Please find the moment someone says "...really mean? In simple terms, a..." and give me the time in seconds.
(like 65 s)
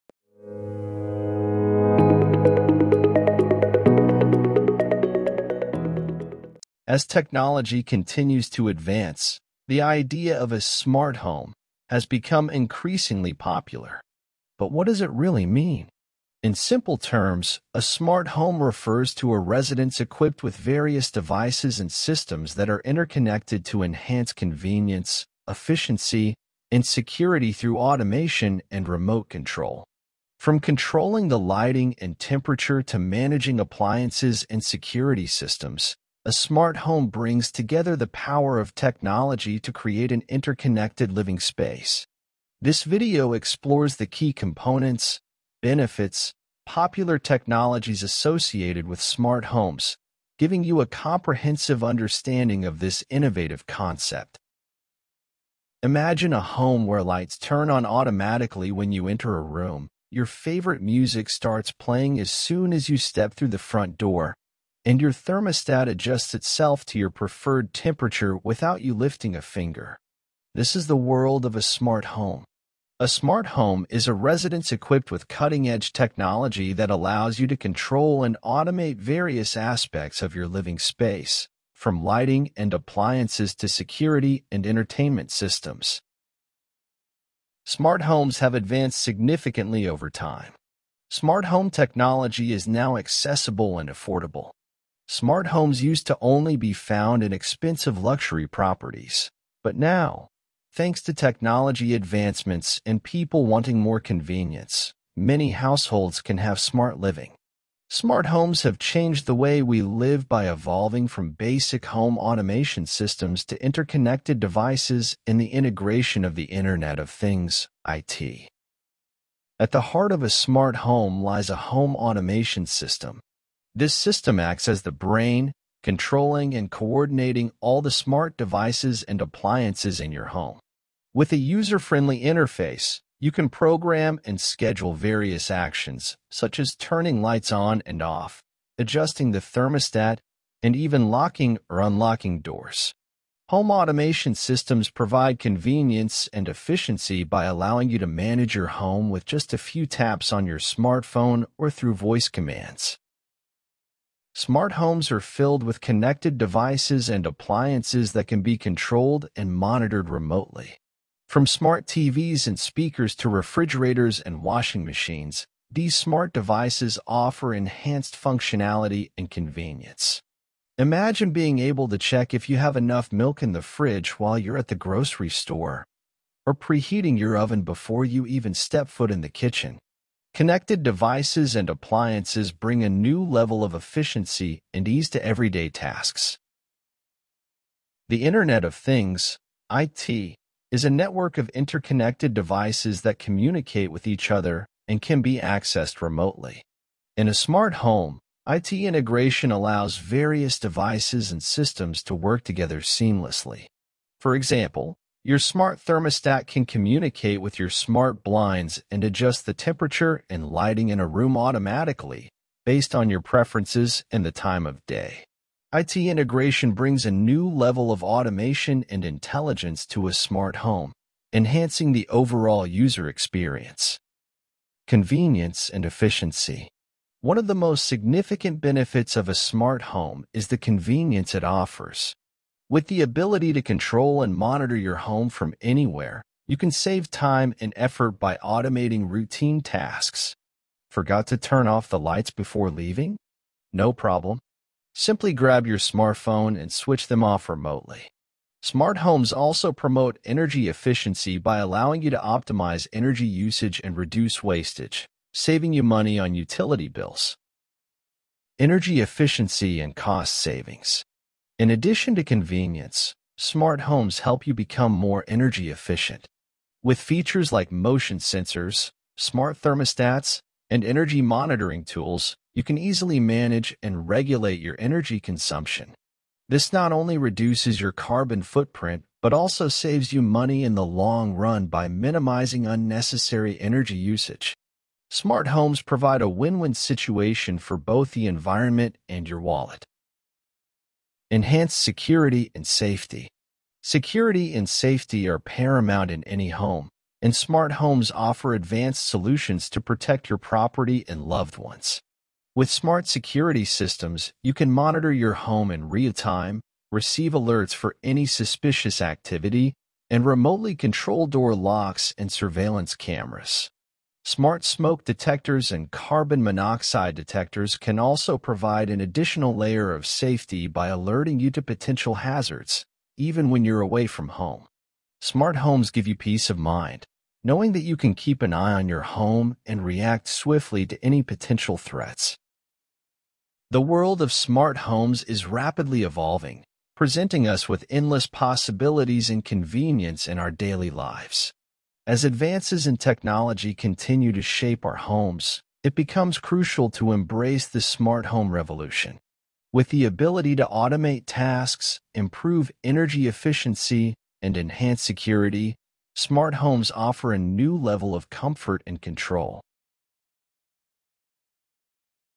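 15 s.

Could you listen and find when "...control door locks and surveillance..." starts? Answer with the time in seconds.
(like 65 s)
310 s.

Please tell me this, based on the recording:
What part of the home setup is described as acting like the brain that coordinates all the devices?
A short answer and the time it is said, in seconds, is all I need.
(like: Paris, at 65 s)
home automation system, at 121 s.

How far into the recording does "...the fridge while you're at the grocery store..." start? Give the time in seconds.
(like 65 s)
173 s.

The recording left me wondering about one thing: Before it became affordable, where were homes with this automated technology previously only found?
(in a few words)
expensive luxury properties.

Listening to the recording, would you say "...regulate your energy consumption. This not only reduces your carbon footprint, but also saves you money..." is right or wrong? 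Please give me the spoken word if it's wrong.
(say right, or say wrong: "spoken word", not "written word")
right.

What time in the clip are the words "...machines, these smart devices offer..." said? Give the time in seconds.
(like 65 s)
164 s.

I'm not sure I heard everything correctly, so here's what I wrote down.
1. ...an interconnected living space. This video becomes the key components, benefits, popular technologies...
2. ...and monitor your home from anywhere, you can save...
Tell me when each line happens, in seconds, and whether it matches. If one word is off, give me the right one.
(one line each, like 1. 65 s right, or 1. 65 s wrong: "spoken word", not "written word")
1. 40 s wrong: "explores", not "becomes"
2. 234 s right.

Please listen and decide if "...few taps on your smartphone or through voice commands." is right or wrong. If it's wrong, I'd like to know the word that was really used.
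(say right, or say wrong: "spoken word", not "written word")
right.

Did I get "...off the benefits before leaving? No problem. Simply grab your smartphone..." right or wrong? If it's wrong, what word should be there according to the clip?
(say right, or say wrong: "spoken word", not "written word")
wrong: "lights", not "benefits".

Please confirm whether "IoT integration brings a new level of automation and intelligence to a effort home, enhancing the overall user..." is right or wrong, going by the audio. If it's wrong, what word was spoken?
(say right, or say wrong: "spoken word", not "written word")
wrong: "smart", not "effort".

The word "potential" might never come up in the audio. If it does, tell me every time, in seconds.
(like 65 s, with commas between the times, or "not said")
321 s, 331 s.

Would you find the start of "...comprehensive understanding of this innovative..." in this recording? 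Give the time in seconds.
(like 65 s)
50 s.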